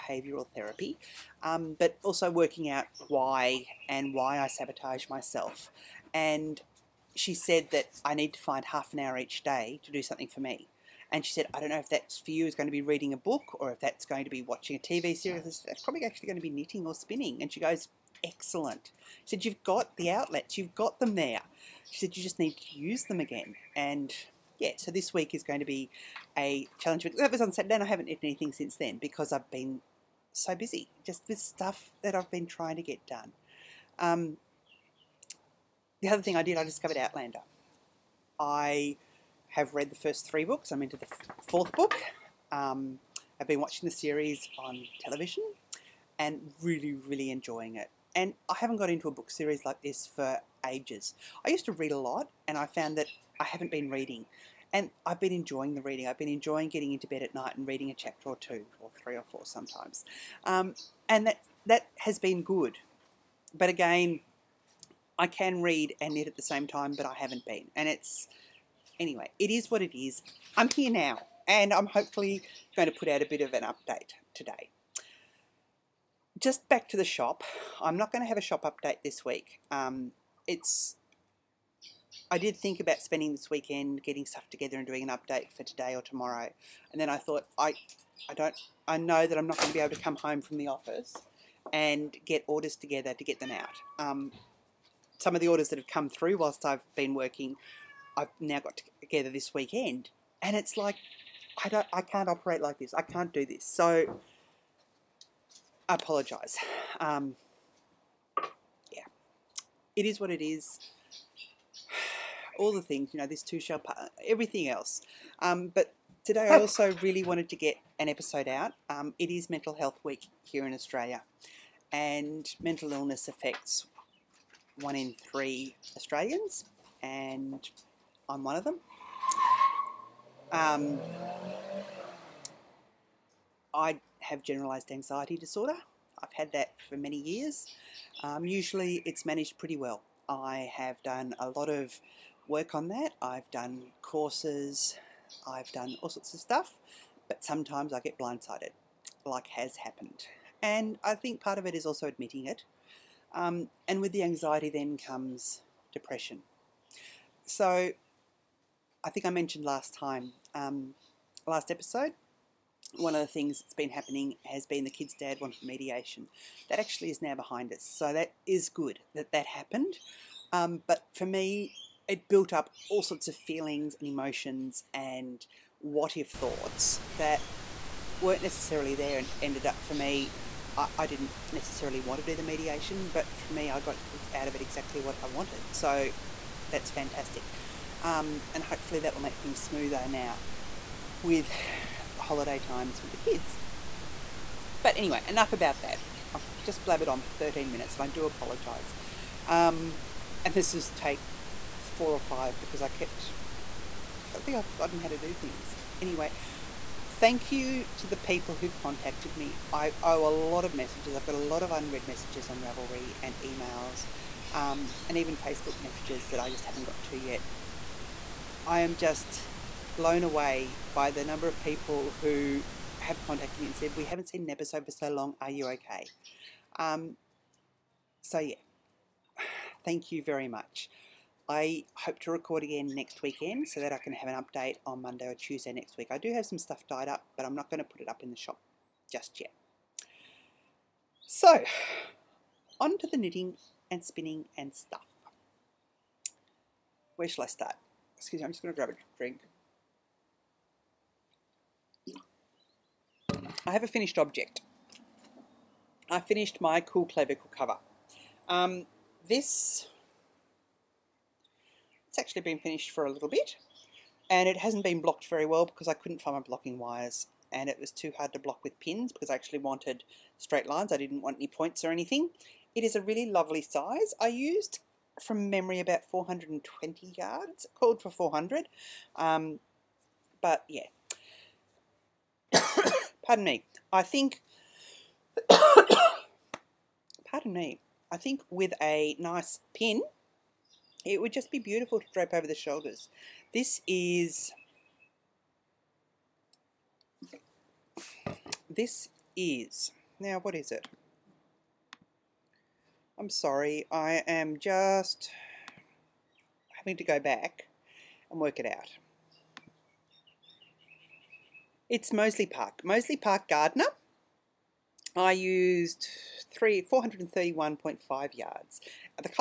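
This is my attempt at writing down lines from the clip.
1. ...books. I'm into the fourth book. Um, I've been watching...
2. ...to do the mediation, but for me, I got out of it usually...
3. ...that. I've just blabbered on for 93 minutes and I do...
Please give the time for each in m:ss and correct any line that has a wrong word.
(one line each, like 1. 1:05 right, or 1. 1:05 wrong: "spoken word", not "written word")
1. 0:40 right
2. 3:02 wrong: "exactly", not "usually"
3. 3:15 wrong: "13", not "93".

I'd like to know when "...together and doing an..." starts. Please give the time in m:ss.
1:24.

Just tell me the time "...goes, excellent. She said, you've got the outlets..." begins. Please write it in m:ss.
0:17.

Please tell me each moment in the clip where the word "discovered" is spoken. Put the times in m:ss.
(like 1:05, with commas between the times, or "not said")
0:36.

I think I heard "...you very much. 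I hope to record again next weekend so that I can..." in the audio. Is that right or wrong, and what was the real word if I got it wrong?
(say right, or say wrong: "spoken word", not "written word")
right.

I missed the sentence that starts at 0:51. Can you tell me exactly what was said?
I used to read a lot and I found that I haven't been reading.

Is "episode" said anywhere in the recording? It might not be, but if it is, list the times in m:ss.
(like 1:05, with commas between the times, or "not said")
1:58, 2:41, 3:44.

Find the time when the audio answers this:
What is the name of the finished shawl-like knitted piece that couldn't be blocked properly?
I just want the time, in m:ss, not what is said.
4:16.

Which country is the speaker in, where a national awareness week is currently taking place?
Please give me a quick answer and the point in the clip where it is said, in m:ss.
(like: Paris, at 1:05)
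Australia, at 2:00.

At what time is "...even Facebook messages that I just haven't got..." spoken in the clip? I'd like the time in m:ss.
3:35.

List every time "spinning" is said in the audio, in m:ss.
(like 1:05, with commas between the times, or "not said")
0:16, 4:04.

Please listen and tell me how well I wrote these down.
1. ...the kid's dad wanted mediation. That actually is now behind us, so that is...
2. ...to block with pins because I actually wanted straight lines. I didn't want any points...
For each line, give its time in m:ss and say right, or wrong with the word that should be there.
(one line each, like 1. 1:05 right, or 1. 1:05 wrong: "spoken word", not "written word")
1. 2:44 right
2. 4:28 right.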